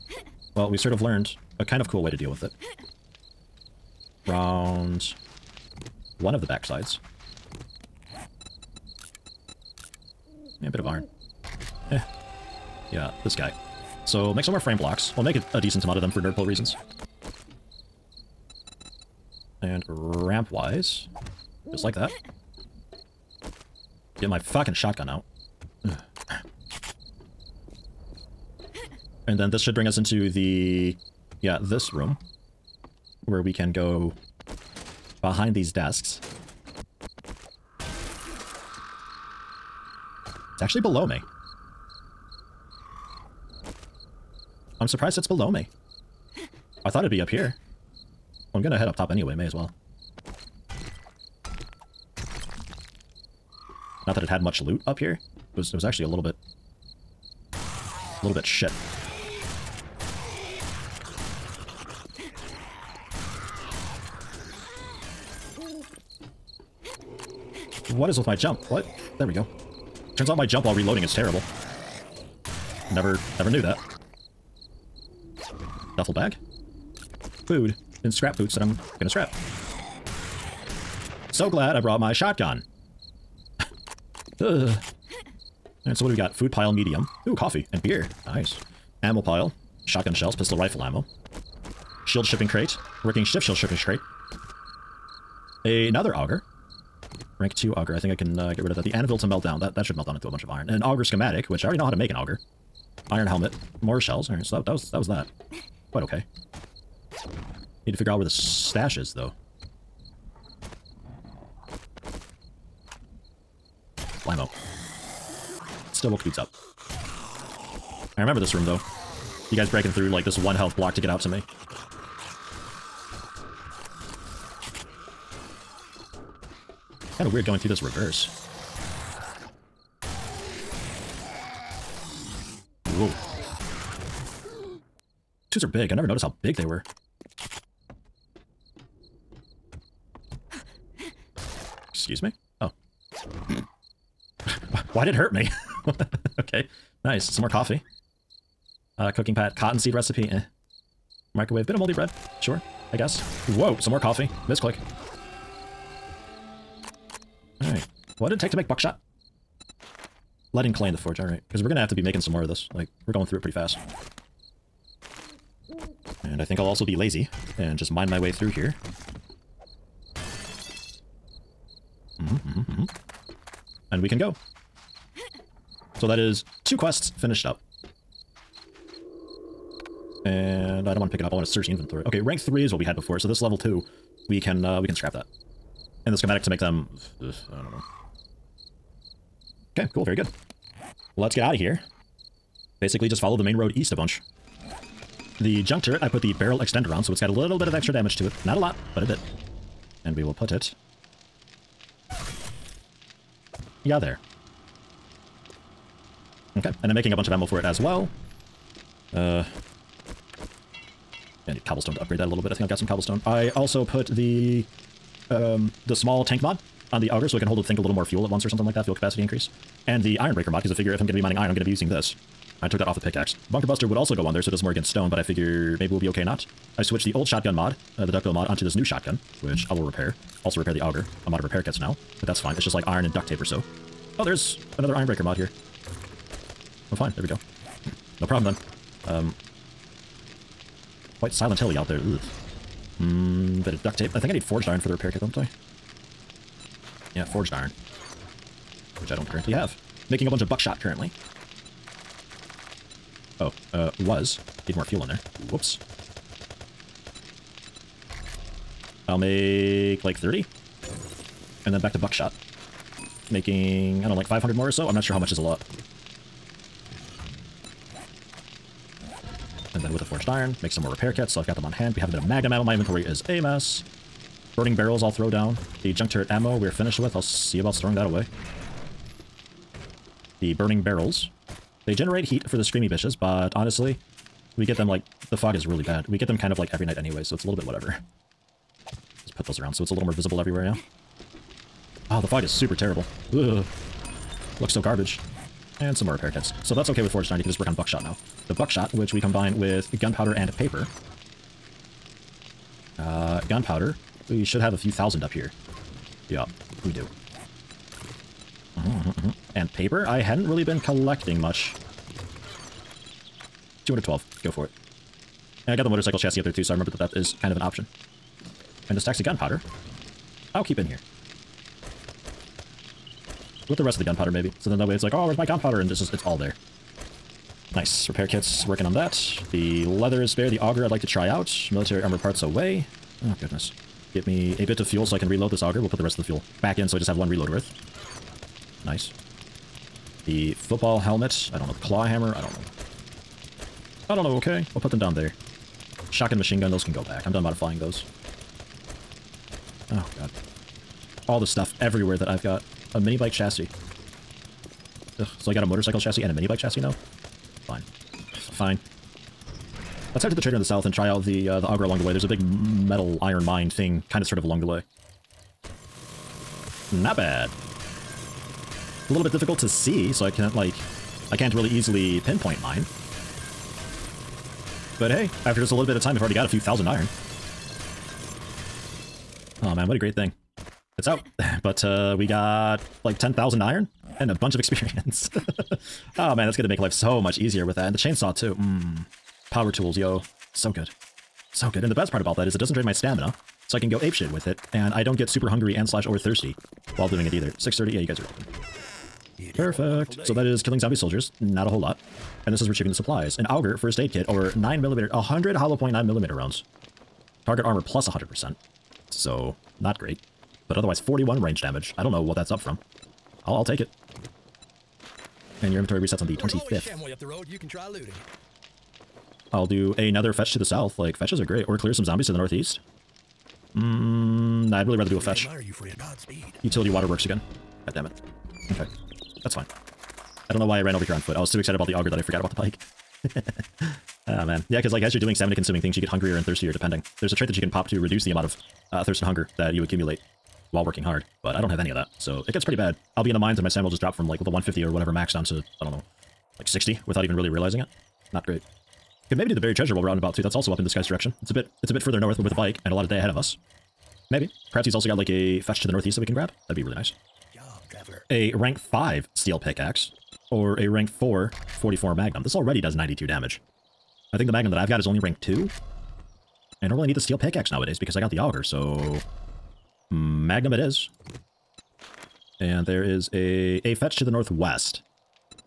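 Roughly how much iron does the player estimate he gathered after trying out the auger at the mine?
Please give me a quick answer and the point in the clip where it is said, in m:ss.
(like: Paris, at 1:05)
10,000, at 6:23.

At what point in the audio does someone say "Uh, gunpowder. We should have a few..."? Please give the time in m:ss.
5:02.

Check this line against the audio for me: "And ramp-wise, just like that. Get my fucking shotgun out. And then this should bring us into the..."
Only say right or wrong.
right.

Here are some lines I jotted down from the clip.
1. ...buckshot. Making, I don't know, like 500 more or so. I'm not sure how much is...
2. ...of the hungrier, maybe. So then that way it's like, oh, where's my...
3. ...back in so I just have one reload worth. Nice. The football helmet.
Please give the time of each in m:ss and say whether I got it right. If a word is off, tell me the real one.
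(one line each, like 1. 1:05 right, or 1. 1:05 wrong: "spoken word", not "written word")
1. 4:21 right
2. 5:23 wrong: "gunpowder", not "hungrier"
3. 5:36 right.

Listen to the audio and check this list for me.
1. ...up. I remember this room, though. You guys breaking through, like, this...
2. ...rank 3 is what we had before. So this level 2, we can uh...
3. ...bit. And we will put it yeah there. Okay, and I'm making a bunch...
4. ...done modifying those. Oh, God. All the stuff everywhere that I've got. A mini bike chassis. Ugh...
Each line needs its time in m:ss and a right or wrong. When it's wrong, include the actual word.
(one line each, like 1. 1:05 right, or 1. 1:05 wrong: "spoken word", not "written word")
1. 1:56 right
2. 3:02 right
3. 3:19 right
4. 5:47 right.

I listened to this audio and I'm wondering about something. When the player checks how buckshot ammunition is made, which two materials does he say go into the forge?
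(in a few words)
Lead and clay.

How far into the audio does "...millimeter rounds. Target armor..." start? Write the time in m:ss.
6:46.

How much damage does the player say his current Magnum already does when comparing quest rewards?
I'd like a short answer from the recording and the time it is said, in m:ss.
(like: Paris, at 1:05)
92, at 7:42.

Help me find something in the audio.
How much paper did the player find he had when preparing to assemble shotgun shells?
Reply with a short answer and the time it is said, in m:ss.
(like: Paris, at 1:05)
212, at 5:13.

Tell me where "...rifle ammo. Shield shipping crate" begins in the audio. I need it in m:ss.
1:30.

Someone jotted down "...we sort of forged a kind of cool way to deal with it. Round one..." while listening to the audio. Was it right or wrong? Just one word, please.
wrong.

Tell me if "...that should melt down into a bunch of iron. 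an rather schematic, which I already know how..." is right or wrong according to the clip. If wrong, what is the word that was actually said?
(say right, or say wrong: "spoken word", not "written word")
wrong: "auger", not "rather".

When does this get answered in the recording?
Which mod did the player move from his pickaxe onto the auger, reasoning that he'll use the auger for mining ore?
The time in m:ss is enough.
3:40.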